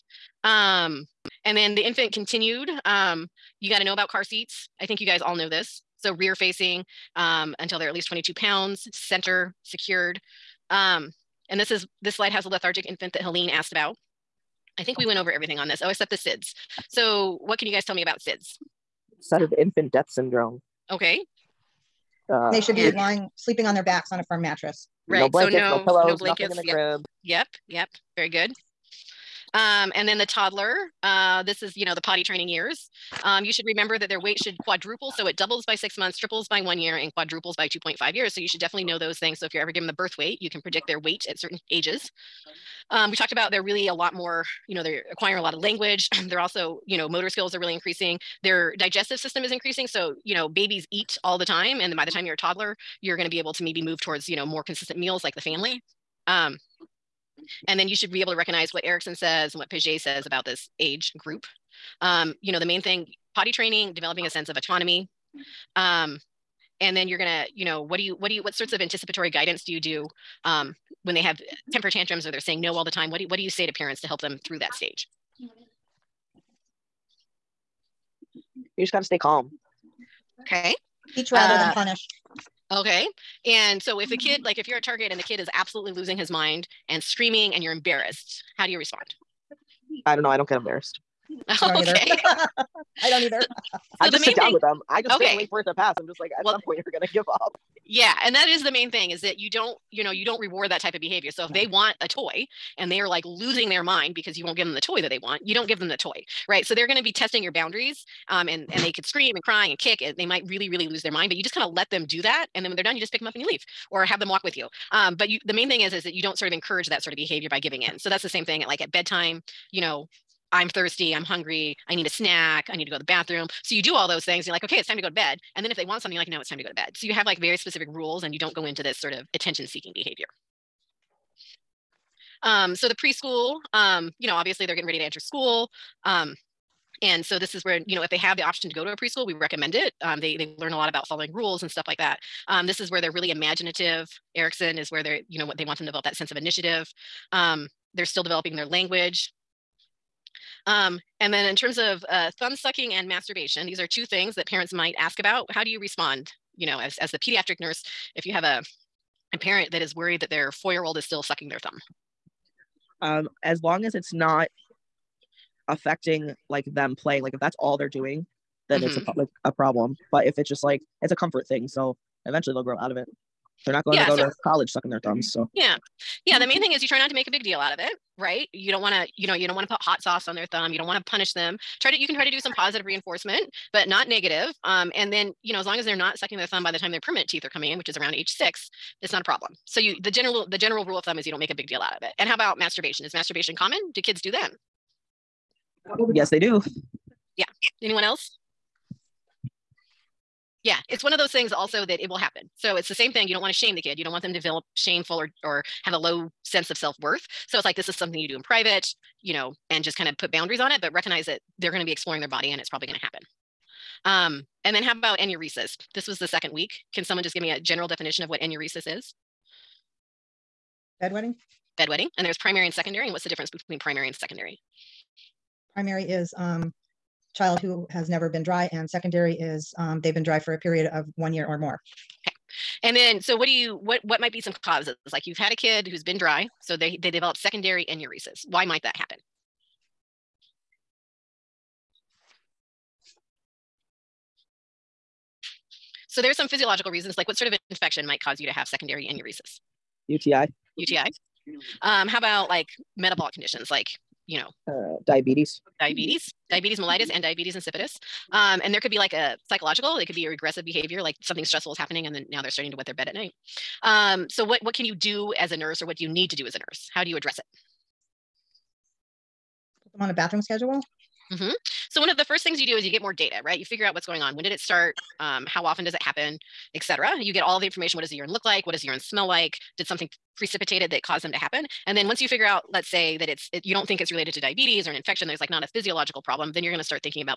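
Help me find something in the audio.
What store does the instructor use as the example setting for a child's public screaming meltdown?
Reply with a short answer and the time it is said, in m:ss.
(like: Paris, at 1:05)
Target, at 1:24.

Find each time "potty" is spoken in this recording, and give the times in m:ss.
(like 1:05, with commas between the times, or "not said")
0:32, 1:03.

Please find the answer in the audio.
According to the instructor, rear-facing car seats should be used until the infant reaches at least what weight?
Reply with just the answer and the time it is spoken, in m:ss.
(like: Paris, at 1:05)
22 pounds, at 0:08.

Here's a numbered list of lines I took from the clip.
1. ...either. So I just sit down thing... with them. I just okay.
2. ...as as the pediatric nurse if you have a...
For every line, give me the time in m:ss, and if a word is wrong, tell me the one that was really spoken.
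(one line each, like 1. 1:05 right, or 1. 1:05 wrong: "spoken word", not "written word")
1. 1:33 right
2. 2:36 right.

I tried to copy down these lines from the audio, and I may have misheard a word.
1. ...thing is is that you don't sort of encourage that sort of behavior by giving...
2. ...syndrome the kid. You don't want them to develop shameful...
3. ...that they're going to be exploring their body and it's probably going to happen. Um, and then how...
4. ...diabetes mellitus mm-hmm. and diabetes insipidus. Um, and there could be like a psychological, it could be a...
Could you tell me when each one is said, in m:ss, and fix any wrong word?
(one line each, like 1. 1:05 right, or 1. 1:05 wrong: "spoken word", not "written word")
1. 1:55 right
2. 3:23 wrong: "shame", not "syndrome"
3. 3:31 right
4. 4:16 right.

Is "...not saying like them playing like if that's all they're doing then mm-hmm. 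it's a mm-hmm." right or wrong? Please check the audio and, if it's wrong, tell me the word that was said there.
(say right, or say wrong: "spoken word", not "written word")
wrong: "affecting", not "saying".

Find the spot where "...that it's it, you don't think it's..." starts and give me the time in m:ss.
4:43.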